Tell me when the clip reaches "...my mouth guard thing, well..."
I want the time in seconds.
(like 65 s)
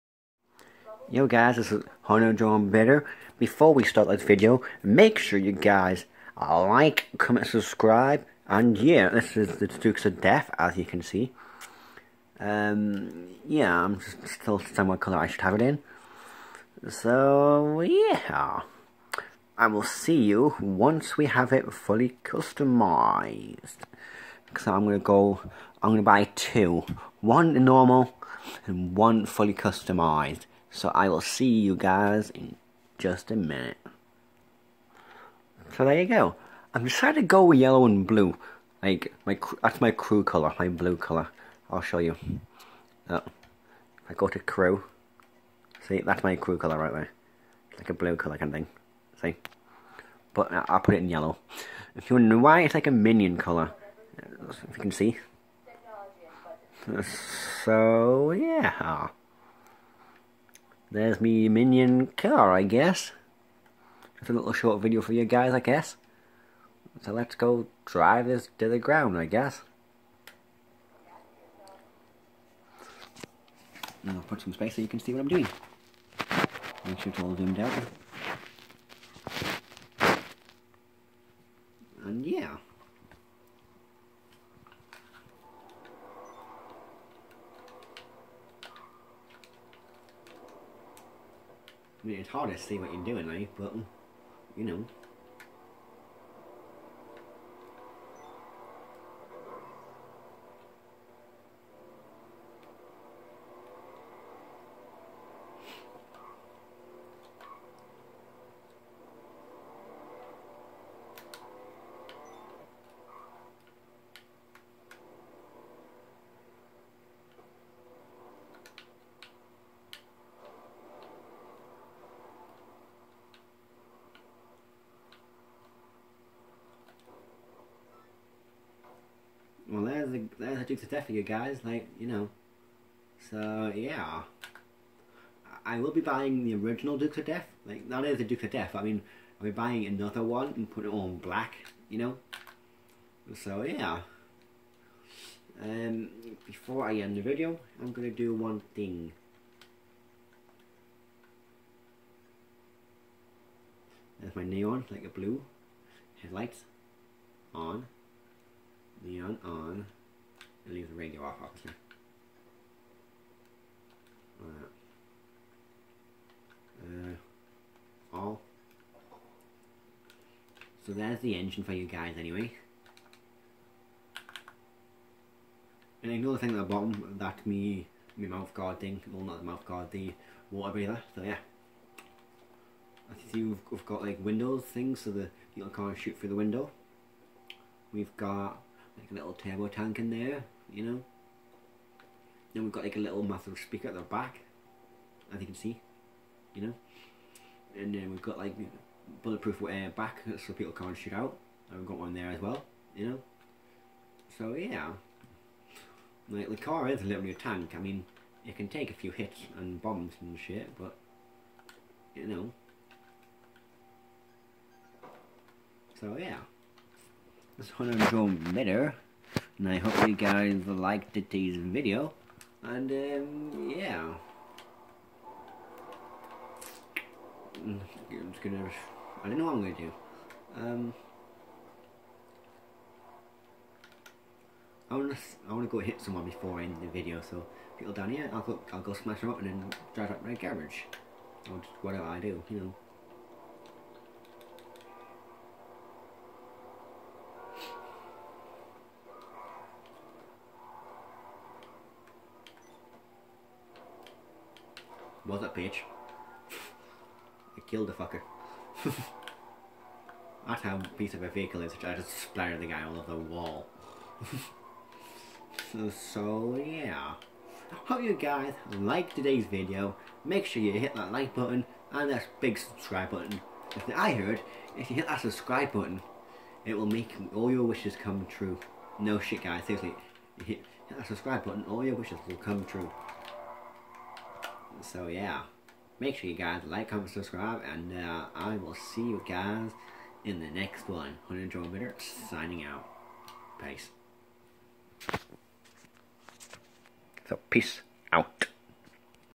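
178 s.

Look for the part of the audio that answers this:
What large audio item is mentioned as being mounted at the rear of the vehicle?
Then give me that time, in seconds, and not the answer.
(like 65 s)
193 s.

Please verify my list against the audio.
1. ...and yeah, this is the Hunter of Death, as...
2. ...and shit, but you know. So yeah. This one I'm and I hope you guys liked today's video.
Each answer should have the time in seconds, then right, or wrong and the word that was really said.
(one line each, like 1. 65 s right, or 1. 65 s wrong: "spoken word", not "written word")
1. 8 s wrong: "Dukes", not "Hunter"
2. 210 s right.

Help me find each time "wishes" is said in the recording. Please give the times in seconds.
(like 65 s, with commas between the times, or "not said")
277 s, 281 s.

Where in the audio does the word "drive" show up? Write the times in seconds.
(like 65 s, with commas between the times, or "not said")
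67 s, 239 s.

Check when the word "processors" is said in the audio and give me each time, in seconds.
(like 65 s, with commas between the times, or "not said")
not said.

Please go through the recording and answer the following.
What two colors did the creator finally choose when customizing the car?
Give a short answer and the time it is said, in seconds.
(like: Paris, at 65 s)
yellow and blue, at 37 s.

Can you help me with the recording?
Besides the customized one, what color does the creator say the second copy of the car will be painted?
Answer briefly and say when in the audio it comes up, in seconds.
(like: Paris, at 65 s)
black, at 141 s.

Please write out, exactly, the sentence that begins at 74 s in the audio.
And I'll put some space so you can see what I'm doing.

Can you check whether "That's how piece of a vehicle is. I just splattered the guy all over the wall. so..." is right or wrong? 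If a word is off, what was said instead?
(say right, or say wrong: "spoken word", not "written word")
right.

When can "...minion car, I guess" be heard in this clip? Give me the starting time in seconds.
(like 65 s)
61 s.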